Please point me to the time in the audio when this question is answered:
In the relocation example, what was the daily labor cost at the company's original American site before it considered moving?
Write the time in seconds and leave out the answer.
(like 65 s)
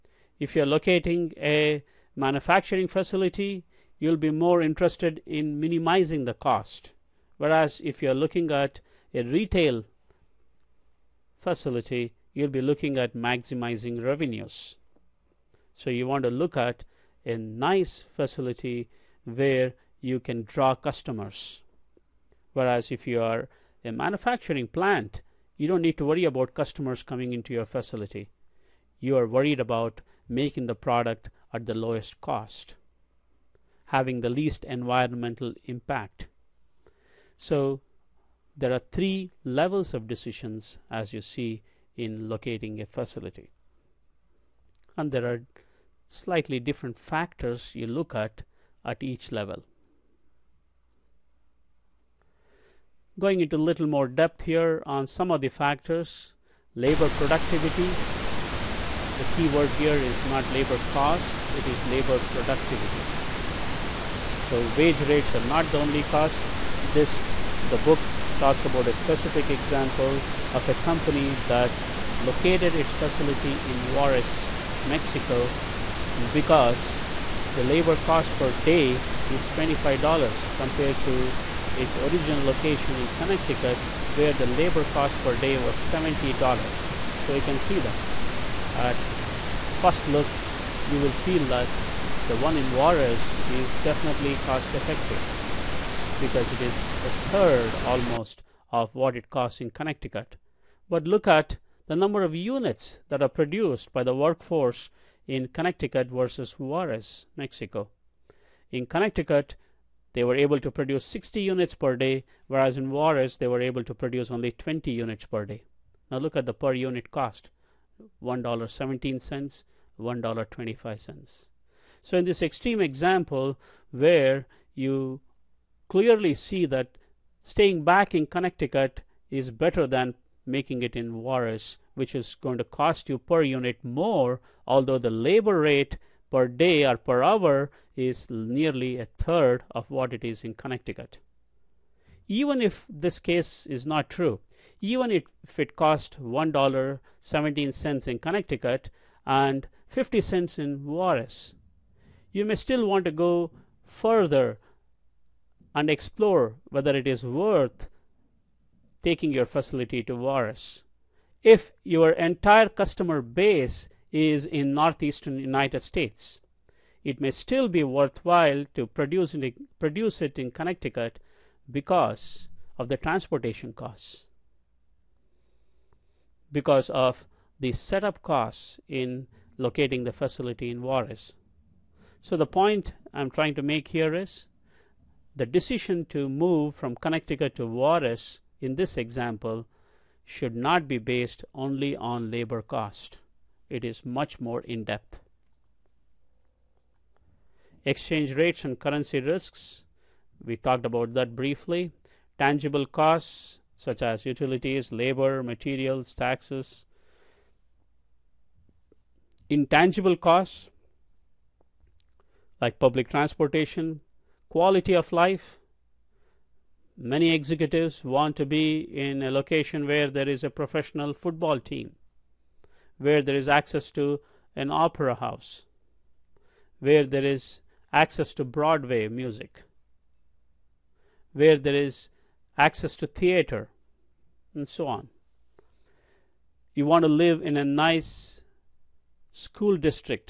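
85 s.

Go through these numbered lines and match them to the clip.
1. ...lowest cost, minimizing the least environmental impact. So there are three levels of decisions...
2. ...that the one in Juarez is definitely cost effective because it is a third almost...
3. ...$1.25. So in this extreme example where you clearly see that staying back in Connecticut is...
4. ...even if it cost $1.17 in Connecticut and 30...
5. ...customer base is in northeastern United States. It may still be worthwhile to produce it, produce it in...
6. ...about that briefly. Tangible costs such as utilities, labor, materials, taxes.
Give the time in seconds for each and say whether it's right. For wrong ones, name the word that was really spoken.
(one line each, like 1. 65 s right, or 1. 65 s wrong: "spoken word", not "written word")
1. 31 s wrong: "having", not "minimizing"
2. 91 s right
3. 119 s right
4. 144 s wrong: "50", not "30"
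5. 162 s right
6. 200 s right.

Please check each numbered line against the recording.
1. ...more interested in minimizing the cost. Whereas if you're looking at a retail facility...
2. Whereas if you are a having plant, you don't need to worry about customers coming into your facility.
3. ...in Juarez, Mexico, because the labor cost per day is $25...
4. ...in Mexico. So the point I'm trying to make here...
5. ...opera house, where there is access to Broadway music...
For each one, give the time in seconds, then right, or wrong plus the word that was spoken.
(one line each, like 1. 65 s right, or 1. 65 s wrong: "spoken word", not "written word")
1. 4 s right
2. 22 s wrong: "manufacturing", not "having"
3. 73 s right
4. 180 s wrong: "Juarez", not "Mexico"
5. 224 s right.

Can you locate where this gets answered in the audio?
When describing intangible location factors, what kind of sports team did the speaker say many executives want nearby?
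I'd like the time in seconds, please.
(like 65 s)
220 s.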